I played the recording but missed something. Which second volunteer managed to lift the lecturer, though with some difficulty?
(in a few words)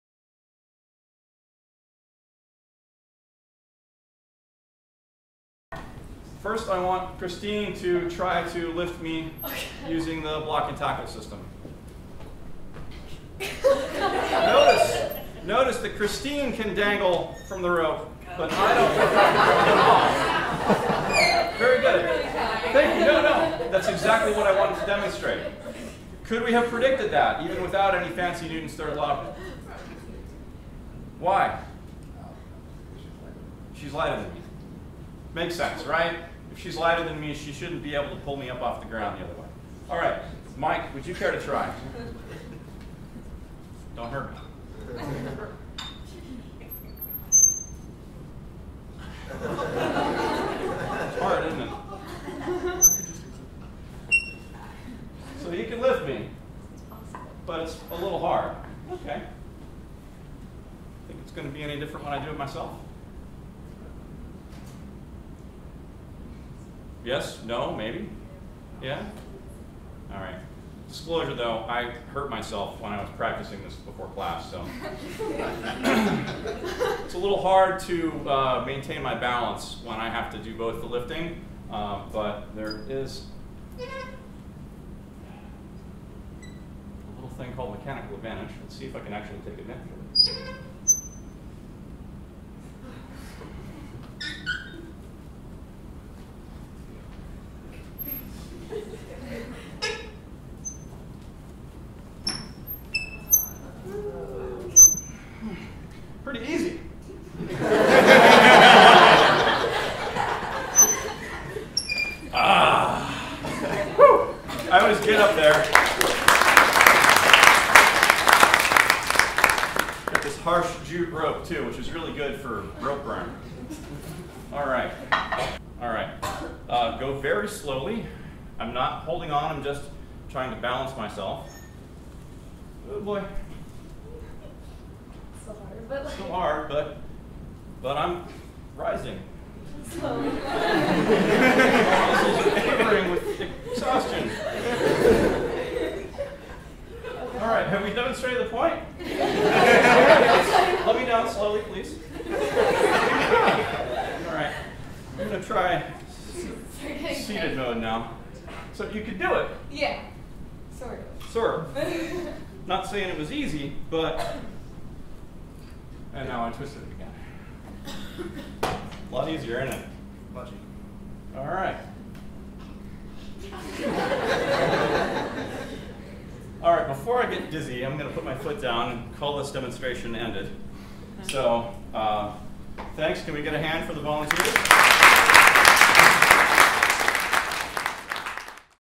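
Mike.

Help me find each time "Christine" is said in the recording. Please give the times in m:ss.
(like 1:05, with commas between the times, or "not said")
0:07, 0:15.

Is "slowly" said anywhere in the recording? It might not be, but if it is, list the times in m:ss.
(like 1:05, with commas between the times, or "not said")
2:07, 2:19, 2:31.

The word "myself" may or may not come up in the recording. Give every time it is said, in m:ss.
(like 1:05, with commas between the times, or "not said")
1:02, 1:12, 2:10.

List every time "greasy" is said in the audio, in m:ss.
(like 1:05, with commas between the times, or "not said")
not said.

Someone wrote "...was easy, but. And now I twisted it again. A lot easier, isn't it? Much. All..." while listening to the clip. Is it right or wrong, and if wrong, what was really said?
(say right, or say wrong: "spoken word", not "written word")
right.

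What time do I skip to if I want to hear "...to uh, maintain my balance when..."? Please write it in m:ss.
1:17.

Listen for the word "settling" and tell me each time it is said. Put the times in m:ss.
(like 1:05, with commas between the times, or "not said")
not said.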